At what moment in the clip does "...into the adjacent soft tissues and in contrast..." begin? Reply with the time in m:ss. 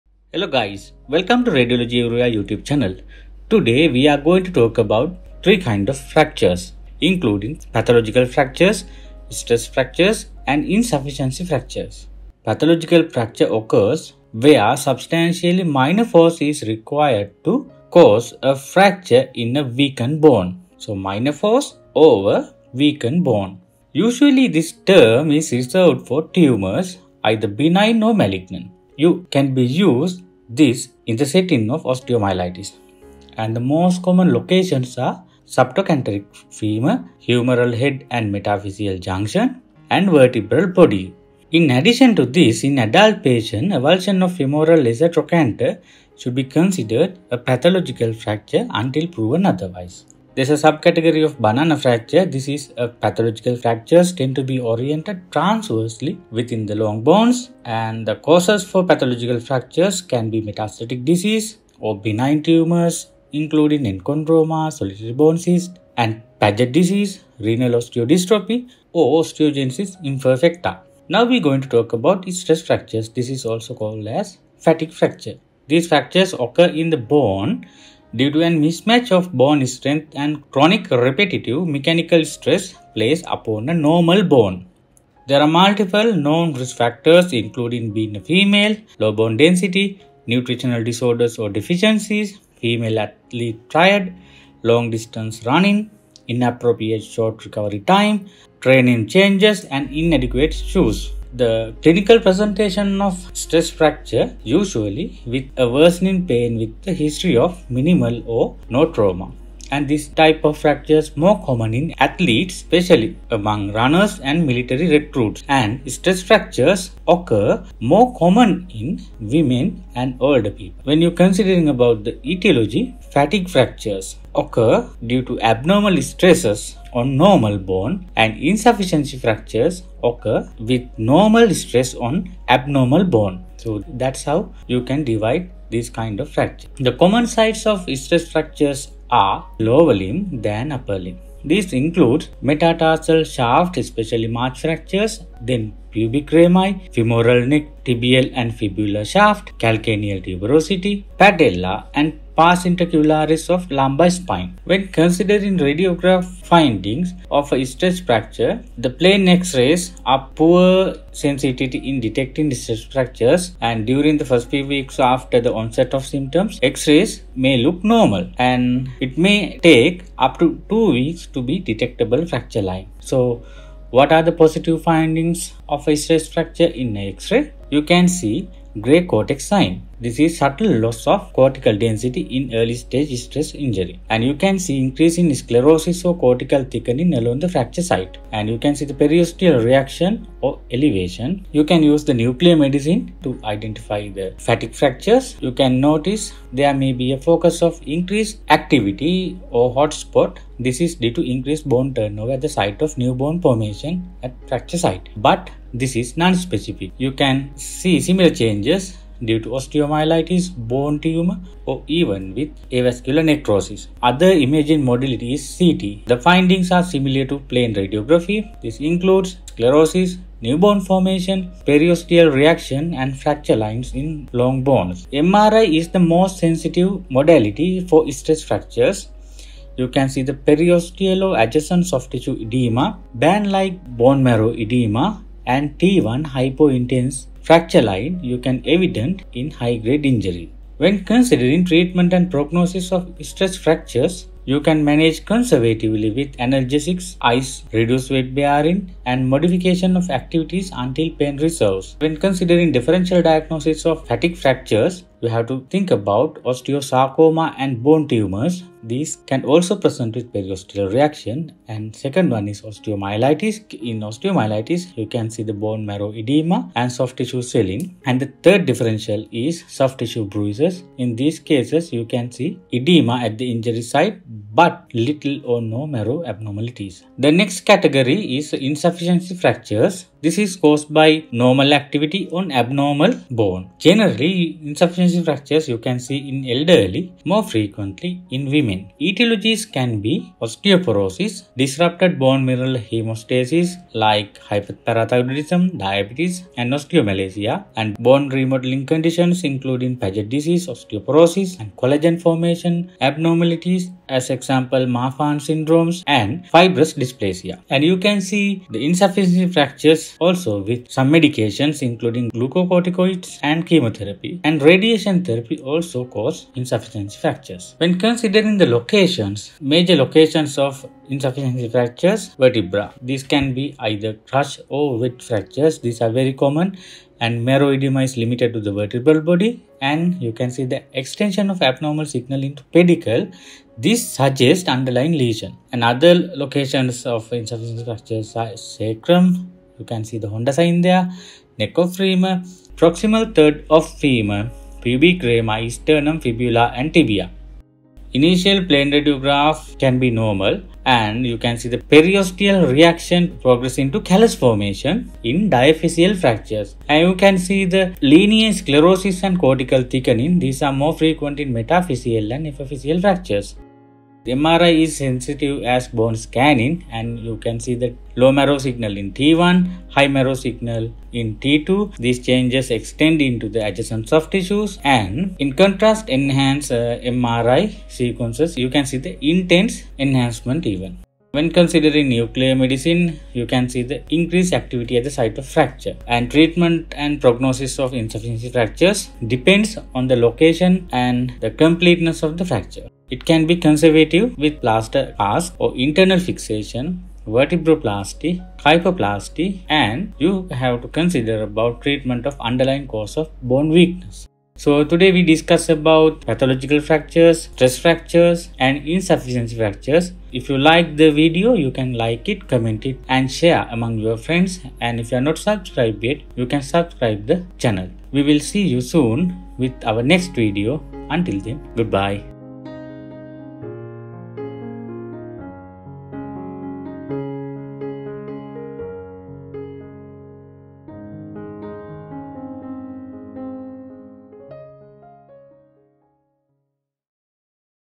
6:13.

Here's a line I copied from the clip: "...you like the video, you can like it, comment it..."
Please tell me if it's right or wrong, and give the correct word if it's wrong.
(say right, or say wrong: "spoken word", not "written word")
right.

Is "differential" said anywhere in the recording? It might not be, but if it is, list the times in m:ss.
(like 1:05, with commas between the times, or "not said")
4:12, 4:28.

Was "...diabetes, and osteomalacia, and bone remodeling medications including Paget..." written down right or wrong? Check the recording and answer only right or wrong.
wrong.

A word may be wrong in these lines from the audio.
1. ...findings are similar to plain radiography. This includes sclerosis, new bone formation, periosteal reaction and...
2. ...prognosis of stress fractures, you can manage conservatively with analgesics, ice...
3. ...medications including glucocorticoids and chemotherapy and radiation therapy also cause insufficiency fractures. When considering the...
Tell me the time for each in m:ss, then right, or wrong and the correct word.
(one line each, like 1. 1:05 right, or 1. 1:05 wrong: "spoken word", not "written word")
1. 3:36 right
2. 4:02 right
3. 5:11 right.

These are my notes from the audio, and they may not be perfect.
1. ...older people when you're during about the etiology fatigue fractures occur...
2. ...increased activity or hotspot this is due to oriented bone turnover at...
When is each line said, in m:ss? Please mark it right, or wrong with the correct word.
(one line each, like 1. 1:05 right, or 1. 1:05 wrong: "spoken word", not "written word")
1. 2:00 wrong: "considering", not "during"
2. 3:17 wrong: "increased", not "oriented".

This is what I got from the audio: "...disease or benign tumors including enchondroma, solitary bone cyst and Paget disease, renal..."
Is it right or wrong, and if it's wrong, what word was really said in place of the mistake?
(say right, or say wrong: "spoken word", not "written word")
right.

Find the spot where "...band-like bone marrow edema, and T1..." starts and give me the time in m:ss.
3:53.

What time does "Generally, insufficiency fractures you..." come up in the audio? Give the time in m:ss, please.
4:43.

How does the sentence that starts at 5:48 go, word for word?
Initial plain radiograph can be normal and you can see the periosteal reaction progress into callus formation in diaphyseal fractures.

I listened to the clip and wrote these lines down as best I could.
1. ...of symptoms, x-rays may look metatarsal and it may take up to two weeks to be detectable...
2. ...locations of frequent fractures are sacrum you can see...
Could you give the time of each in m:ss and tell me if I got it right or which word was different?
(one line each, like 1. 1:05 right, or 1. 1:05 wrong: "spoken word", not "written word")
1. 2:45 wrong: "normal", not "metatarsal"
2. 5:36 wrong: "insufficient", not "frequent".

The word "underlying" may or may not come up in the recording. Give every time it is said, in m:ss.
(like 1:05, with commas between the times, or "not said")
5:34, 6:42.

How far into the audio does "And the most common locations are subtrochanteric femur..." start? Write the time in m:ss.
0:33.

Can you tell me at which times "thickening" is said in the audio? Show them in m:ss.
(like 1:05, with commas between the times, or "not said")
3:06, 5:59.